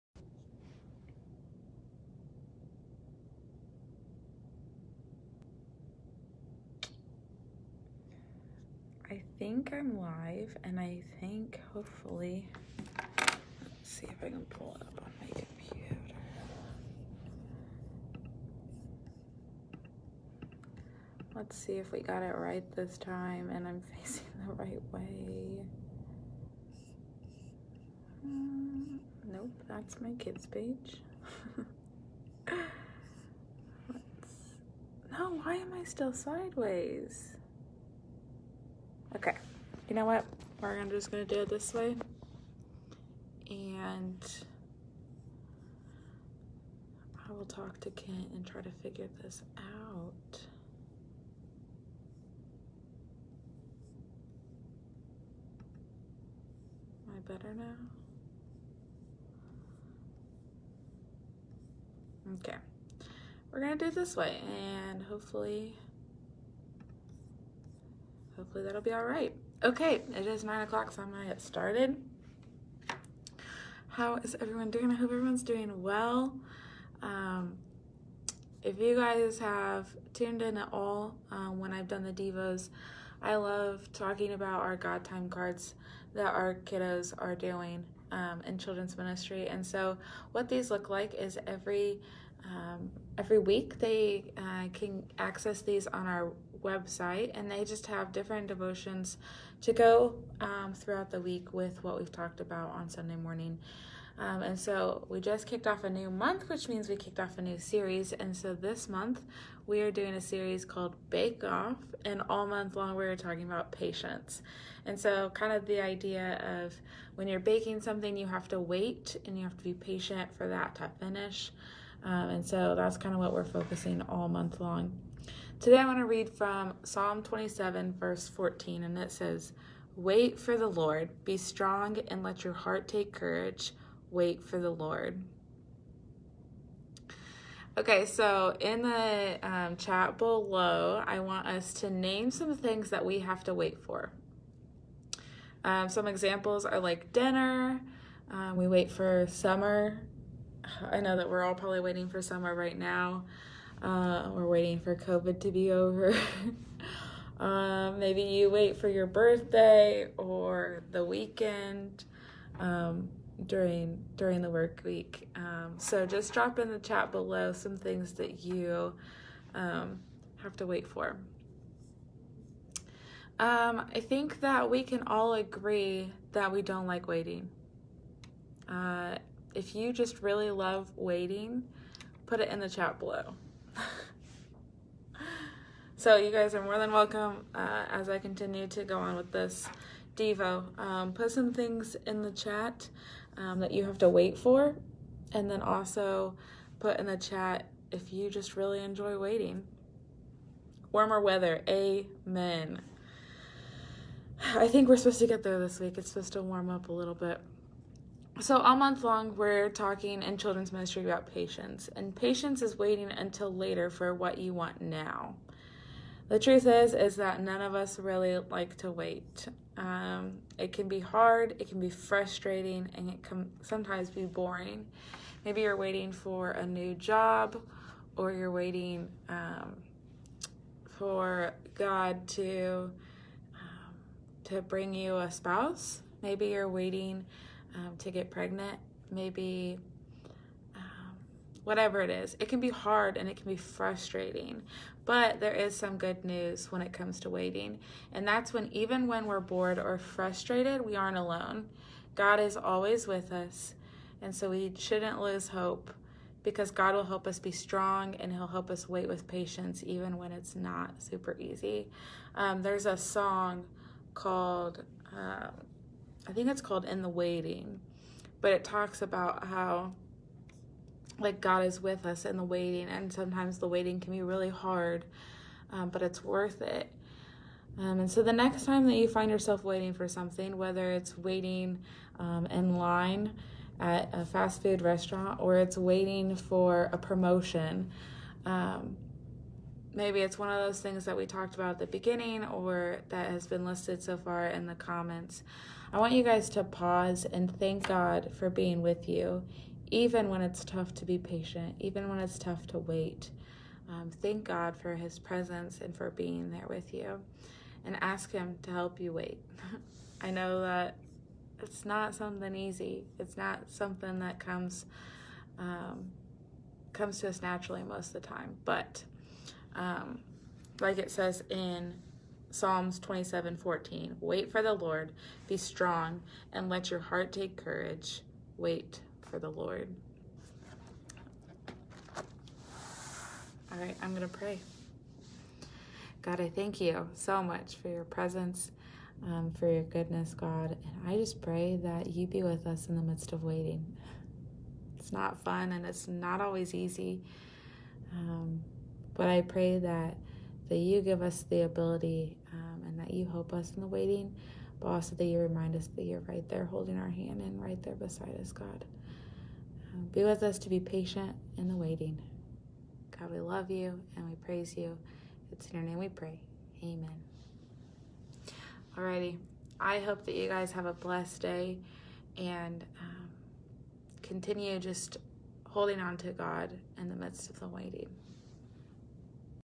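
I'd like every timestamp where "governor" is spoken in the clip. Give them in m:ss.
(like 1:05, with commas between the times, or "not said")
not said.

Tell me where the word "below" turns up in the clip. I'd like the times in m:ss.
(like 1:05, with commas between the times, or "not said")
2:20, 2:47, 3:02.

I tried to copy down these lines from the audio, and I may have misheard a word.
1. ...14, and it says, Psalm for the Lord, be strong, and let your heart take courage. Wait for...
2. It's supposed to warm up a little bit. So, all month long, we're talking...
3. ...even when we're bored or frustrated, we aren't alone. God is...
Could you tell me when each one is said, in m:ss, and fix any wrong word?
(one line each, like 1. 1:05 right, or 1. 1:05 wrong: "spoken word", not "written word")
1. 2:08 wrong: "Wait", not "Psalm"
2. 3:25 right
3. 4:08 right.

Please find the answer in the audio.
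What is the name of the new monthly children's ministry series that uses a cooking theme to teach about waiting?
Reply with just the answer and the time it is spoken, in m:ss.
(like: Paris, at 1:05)
Bake Off, at 1:51.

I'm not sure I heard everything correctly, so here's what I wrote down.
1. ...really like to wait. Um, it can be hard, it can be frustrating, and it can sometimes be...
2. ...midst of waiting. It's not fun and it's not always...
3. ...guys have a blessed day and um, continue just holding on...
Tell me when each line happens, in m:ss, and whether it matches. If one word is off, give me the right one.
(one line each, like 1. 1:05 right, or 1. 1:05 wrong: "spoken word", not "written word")
1. 3:37 right
2. 5:43 right
3. 6:10 right.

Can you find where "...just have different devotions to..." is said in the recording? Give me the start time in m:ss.
1:37.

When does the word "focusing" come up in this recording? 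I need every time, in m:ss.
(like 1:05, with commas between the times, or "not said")
2:03.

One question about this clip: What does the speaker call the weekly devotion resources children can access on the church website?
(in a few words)
God Time cards.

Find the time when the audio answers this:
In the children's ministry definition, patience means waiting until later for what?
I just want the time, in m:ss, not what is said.
3:34.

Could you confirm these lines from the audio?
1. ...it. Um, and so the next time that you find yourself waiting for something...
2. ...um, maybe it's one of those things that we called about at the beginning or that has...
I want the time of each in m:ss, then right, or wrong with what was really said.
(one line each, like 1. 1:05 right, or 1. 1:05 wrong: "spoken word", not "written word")
1. 4:36 right
2. 4:48 wrong: "talked", not "called".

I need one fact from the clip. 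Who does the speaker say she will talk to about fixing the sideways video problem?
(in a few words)
Kent.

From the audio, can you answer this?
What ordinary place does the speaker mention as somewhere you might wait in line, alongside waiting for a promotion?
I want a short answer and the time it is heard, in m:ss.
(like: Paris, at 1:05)
fast food restaurant, at 4:44.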